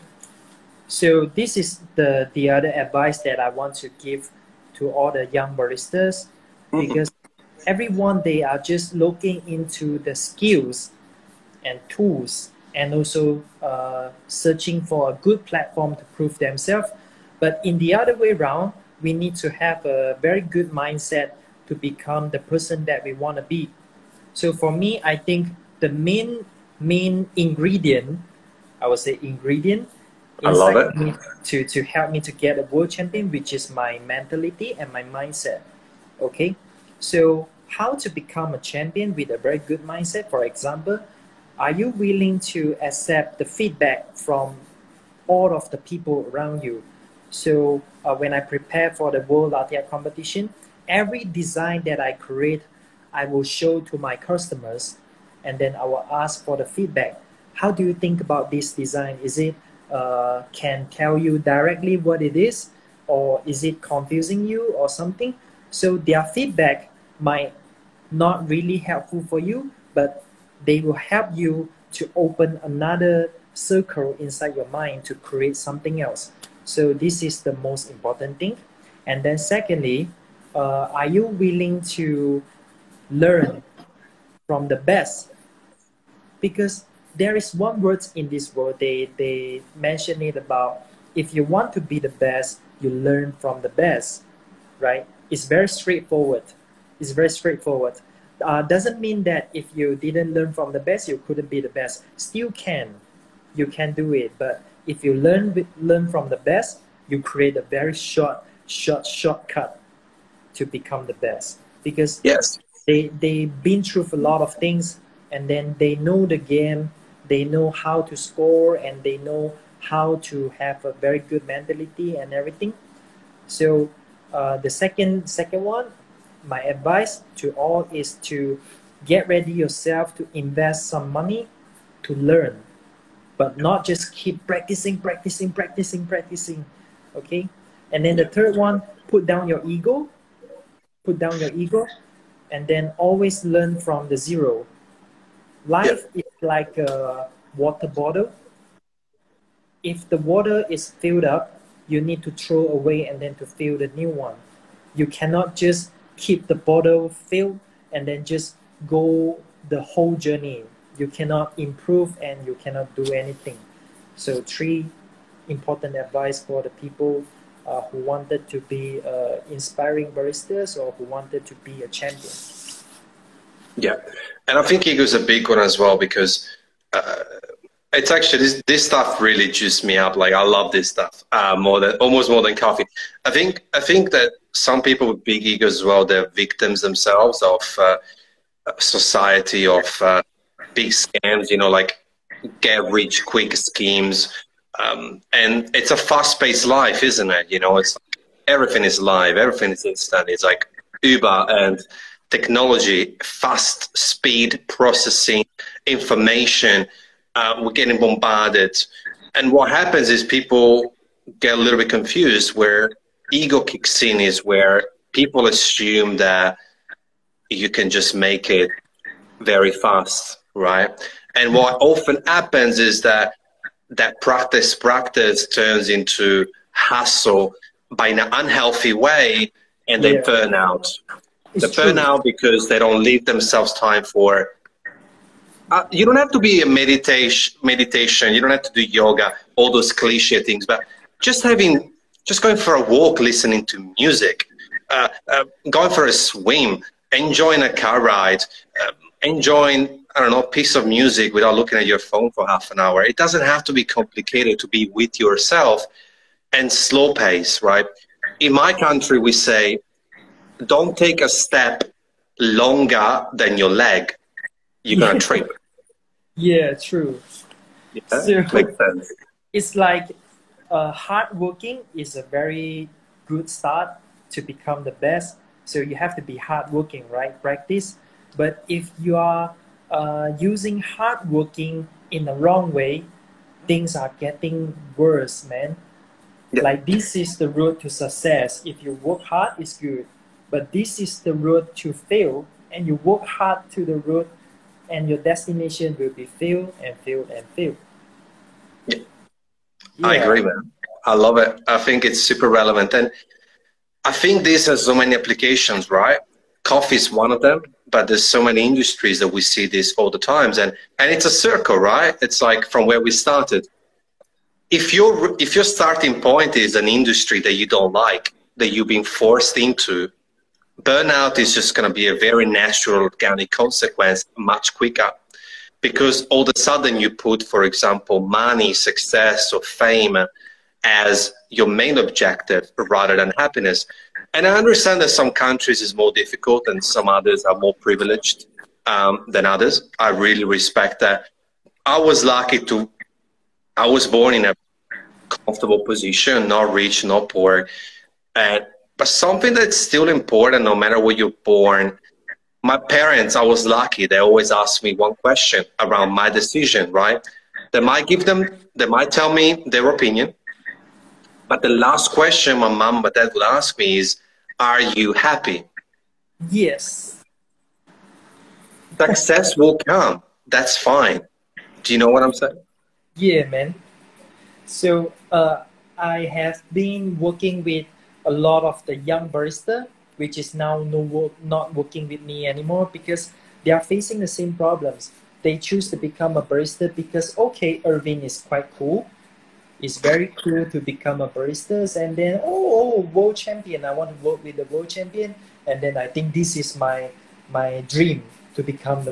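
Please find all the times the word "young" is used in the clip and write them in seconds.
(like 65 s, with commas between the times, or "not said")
5 s, 378 s.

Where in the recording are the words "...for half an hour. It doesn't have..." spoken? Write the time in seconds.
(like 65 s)
252 s.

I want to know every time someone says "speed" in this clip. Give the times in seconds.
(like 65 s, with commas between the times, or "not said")
203 s.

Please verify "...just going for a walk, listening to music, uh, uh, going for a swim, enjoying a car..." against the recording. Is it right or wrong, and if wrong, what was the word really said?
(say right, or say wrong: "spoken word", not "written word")
right.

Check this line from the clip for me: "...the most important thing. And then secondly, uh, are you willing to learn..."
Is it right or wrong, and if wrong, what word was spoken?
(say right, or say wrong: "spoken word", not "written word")
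right.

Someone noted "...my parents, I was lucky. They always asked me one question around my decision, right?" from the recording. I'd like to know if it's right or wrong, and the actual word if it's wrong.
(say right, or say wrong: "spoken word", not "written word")
right.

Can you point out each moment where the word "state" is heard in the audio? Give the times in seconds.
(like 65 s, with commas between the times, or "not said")
not said.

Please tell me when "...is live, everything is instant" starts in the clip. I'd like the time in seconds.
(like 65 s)
198 s.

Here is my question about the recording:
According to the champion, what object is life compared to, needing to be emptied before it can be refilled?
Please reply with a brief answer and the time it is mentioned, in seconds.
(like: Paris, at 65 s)
Water bottle, at 147 s.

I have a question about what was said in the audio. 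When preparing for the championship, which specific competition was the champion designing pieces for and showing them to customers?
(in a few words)
World Latte competition.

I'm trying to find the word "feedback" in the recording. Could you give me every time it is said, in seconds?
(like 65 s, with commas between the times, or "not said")
43 s, 56 s, 66 s.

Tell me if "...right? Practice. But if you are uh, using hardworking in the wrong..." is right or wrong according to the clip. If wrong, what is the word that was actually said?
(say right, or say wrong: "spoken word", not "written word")
right.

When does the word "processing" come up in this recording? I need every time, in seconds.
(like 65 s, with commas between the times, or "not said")
204 s.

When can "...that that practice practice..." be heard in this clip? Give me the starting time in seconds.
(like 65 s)
223 s.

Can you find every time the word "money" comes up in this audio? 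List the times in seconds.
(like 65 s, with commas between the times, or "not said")
131 s, 328 s.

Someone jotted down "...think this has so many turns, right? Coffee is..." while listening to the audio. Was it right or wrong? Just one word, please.
wrong.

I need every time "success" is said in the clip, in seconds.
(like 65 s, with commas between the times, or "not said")
287 s, 328 s, 368 s.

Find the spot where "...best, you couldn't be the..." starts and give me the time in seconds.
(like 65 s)
100 s.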